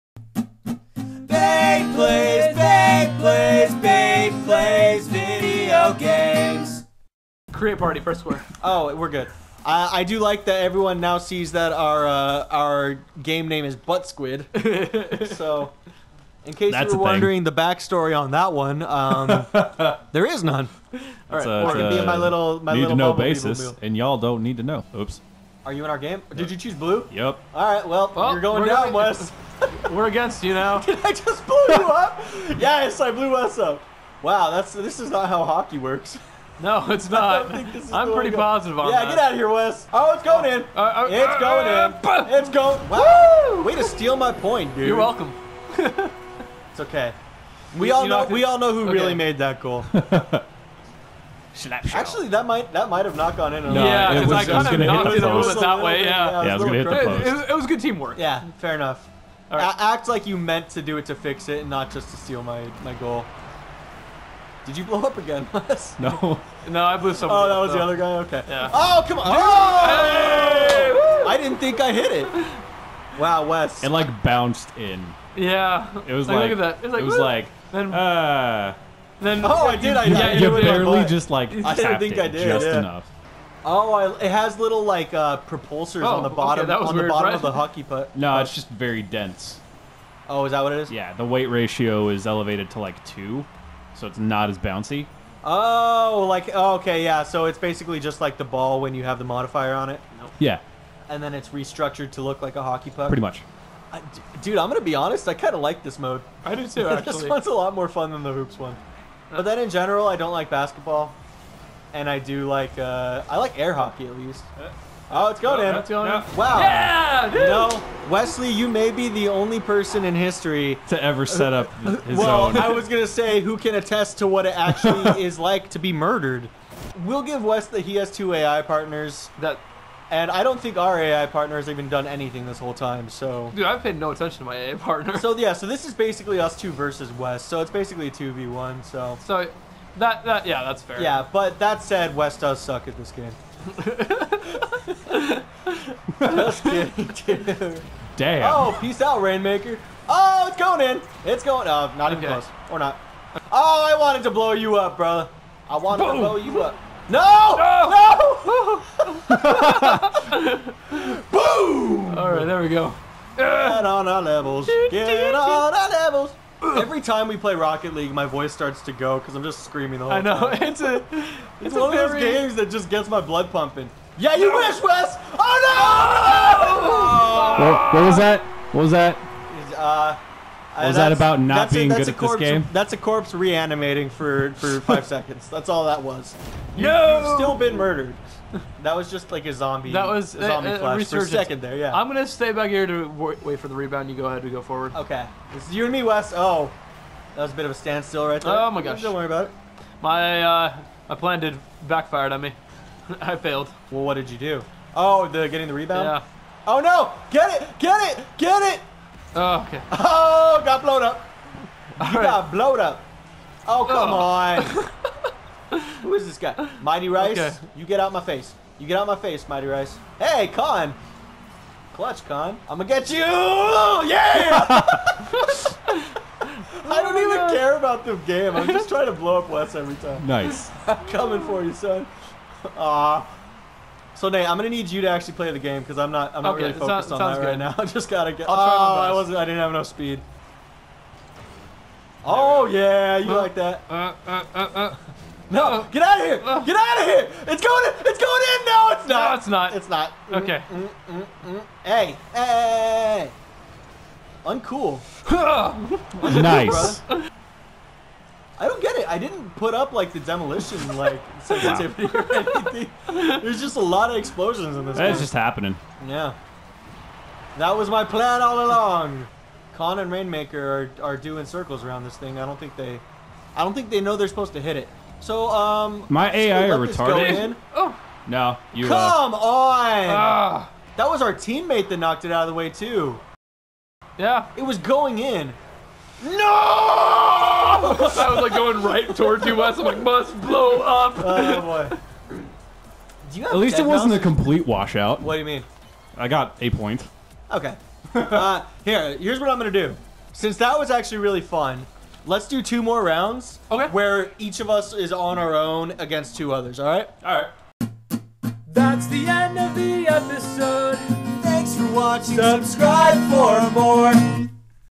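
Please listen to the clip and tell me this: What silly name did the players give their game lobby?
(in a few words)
Butt Squid.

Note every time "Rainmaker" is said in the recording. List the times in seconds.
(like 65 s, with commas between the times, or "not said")
149 s, 270 s.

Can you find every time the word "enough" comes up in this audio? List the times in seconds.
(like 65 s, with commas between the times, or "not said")
58 s, 82 s, 239 s.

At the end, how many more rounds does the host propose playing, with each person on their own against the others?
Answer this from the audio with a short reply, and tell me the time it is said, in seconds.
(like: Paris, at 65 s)
2, at 302 s.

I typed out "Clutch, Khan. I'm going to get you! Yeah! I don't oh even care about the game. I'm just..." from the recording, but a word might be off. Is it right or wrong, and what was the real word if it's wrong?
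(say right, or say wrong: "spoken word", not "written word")
right.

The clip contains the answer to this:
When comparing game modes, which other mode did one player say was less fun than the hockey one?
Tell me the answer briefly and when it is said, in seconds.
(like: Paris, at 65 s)
hoops, at 108 s.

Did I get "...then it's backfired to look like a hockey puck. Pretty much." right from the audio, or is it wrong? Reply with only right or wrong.
wrong.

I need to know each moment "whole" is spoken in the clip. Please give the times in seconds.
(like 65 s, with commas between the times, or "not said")
132 s, 170 s.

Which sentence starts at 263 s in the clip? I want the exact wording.
There's just a lot of explosions in this.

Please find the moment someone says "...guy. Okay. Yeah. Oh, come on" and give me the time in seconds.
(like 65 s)
67 s.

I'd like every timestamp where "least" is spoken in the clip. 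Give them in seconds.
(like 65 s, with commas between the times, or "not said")
114 s, 293 s.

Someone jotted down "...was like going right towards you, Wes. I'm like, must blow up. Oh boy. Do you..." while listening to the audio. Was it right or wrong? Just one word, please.
right.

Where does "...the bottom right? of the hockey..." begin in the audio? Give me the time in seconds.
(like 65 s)
87 s.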